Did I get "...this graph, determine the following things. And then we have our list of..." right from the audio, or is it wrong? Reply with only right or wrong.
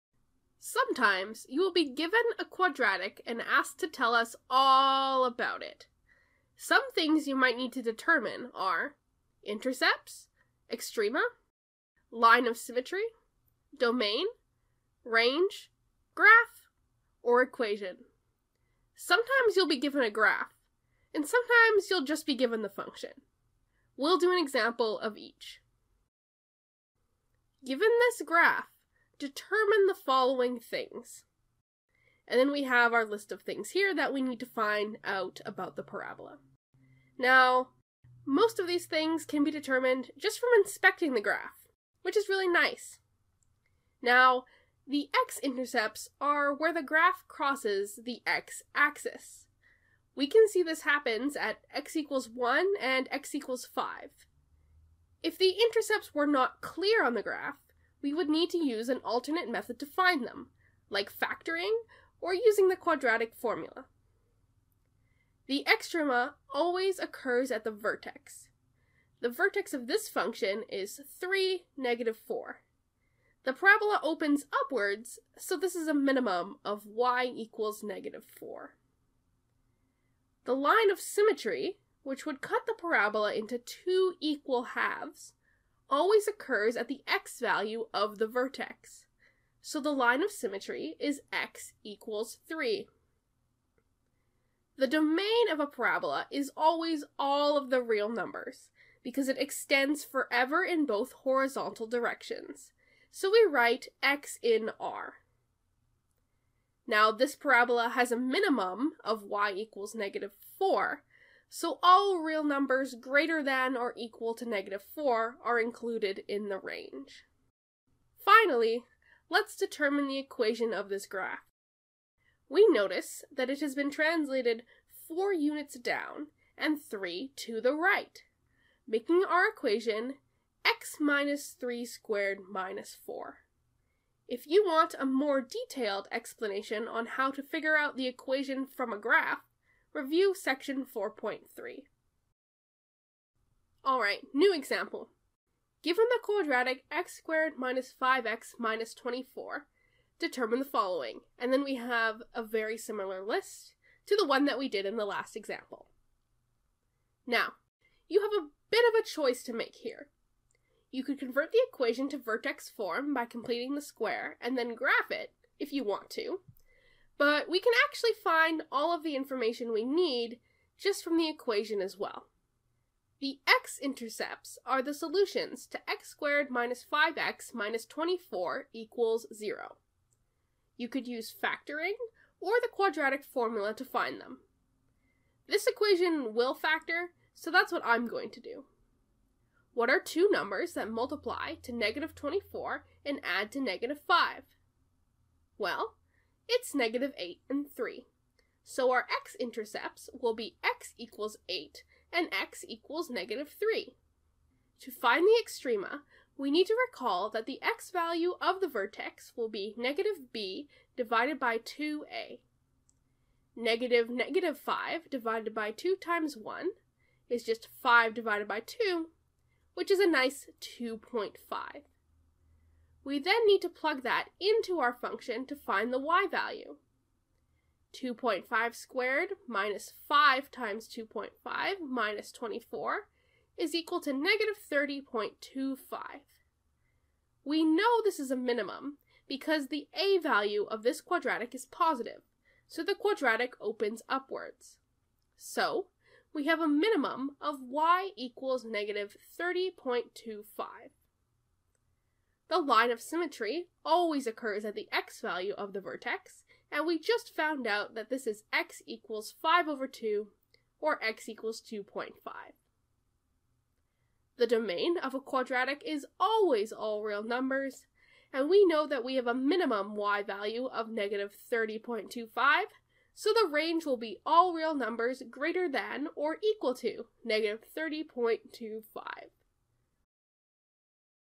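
right.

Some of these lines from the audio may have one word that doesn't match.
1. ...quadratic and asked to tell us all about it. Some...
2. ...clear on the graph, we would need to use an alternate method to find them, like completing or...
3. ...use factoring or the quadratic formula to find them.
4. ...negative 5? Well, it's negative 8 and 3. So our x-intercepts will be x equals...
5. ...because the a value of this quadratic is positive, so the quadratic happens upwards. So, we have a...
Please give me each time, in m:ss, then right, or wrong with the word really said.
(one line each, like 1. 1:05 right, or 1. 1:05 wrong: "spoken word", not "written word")
1. 0:02 right
2. 0:56 wrong: "factoring", not "completing"
3. 3:01 right
4. 3:13 right
5. 3:59 wrong: "opens", not "happens".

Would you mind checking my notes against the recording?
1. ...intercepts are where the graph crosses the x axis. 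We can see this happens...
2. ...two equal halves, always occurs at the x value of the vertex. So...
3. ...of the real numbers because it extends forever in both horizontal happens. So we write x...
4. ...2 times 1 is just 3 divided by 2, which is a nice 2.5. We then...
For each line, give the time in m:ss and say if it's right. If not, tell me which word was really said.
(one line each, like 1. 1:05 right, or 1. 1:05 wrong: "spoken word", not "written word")
1. 0:45 right
2. 1:23 right
3. 1:37 wrong: "directions", not "happens"
4. 3:35 wrong: "5", not "3".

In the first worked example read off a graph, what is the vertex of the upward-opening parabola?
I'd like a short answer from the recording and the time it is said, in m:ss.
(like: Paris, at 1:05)
(3, -4), at 1:11.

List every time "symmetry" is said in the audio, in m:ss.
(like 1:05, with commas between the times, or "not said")
0:12, 1:20, 1:30, 4:12.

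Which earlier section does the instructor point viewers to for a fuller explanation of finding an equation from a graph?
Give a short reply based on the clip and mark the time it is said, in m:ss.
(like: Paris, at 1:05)
Section 4.3, at 2:20.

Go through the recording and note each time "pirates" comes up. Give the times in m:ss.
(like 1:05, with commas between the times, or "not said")
not said.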